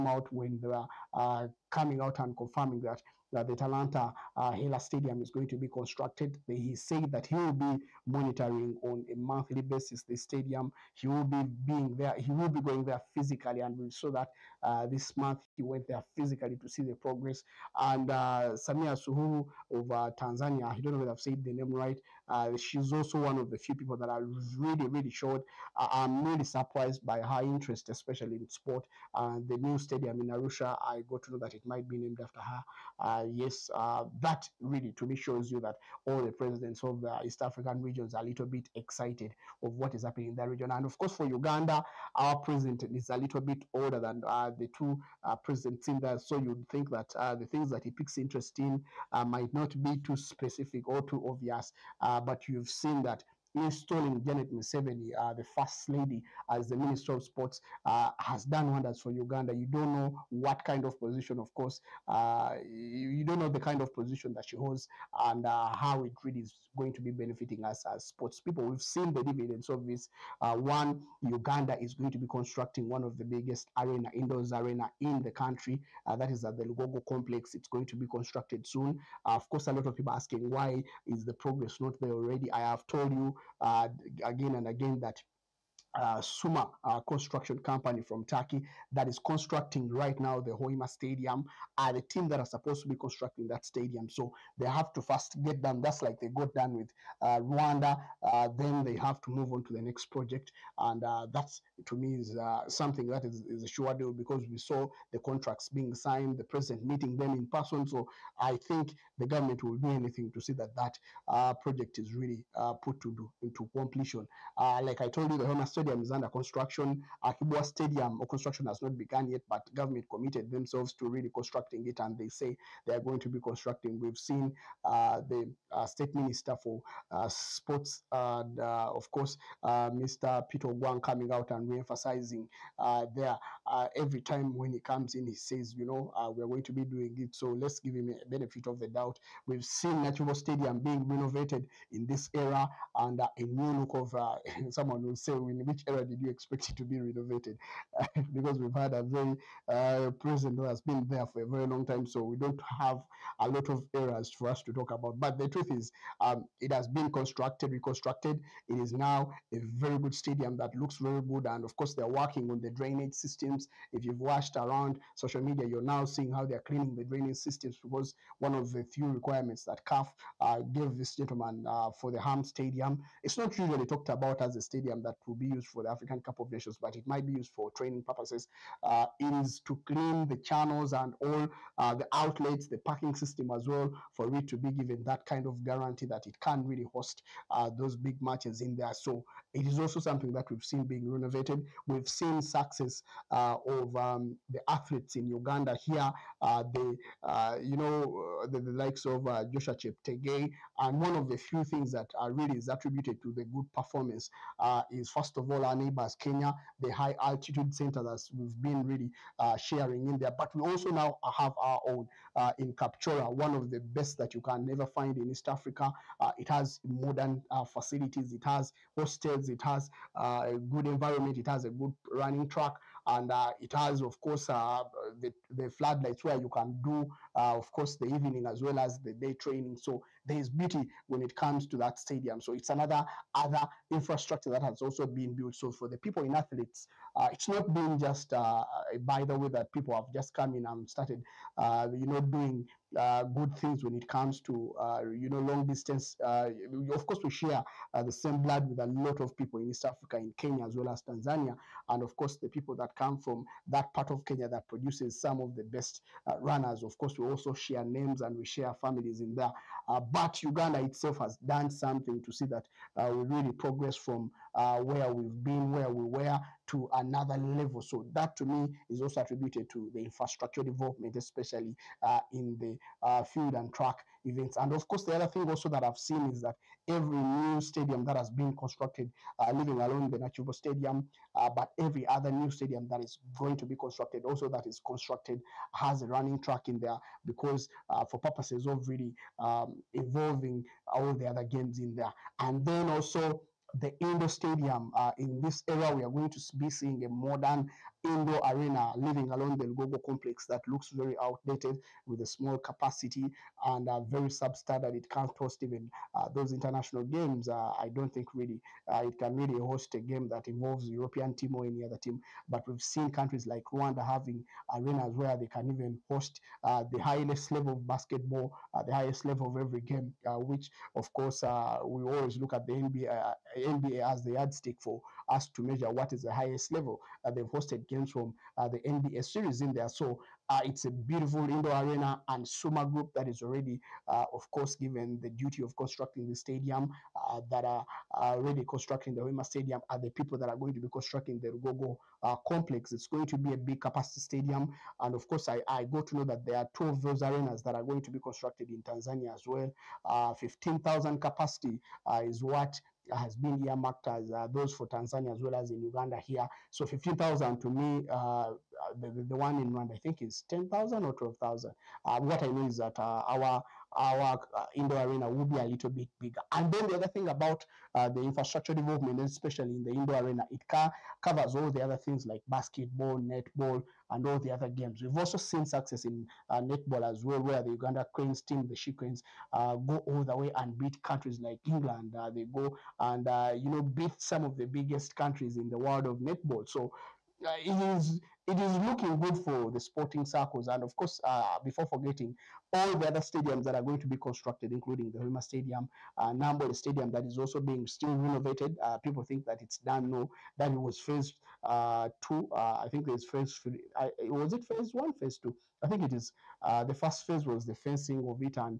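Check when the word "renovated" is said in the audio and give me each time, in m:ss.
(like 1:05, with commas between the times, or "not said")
2:21, 2:26, 3:11, 6:38.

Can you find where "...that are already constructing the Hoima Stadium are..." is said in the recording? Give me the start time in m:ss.
5:37.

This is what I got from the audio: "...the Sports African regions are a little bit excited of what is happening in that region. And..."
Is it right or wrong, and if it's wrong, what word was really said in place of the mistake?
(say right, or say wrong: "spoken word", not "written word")
wrong: "East", not "Sports".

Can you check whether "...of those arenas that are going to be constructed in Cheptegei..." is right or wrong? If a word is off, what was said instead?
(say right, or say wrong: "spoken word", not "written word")
wrong: "Tanzania", not "Cheptegei".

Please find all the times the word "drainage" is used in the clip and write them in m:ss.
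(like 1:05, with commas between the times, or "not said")
2:42, 2:47.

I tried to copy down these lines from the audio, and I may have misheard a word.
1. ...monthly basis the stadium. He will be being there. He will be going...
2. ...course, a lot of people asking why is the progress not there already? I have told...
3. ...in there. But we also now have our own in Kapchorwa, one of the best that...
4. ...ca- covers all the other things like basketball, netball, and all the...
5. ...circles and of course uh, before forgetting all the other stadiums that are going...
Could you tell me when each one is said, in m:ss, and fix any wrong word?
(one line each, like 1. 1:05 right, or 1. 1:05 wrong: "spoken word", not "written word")
1. 0:09 right
2. 1:19 right
3. 3:30 right
4. 6:10 right
5. 6:30 right.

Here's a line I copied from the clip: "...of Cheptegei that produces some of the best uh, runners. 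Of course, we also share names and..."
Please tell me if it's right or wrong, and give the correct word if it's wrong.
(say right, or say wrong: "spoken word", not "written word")
wrong: "Kenya", not "Cheptegei".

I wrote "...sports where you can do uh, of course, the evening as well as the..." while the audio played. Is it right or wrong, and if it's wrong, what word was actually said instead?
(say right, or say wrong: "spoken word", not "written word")
wrong: "floodlights", not "sports".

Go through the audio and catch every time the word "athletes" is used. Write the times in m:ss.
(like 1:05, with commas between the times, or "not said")
3:14, 3:56.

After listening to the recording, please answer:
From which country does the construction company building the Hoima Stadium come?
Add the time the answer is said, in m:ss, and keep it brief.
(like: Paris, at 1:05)
Turkey, at 1:28.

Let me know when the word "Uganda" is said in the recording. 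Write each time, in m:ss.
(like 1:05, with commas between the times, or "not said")
0:41, 0:59, 1:11, 3:15, 4:20, 5:55, 6:17.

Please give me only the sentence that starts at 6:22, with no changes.
Uh, they go and uh, you know beat some of the biggest countries in the world of netball.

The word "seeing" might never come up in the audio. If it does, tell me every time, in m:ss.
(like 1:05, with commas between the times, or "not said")
2:46, 4:56.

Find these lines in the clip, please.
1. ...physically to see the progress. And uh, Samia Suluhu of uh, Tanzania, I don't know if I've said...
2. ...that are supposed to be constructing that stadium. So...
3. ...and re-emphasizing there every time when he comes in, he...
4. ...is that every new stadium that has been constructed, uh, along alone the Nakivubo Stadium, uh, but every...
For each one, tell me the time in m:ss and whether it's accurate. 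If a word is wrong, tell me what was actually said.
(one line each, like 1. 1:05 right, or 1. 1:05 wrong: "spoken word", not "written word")
1. 0:16 right
2. 1:32 right
3. 2:11 right
4. 4:36 right.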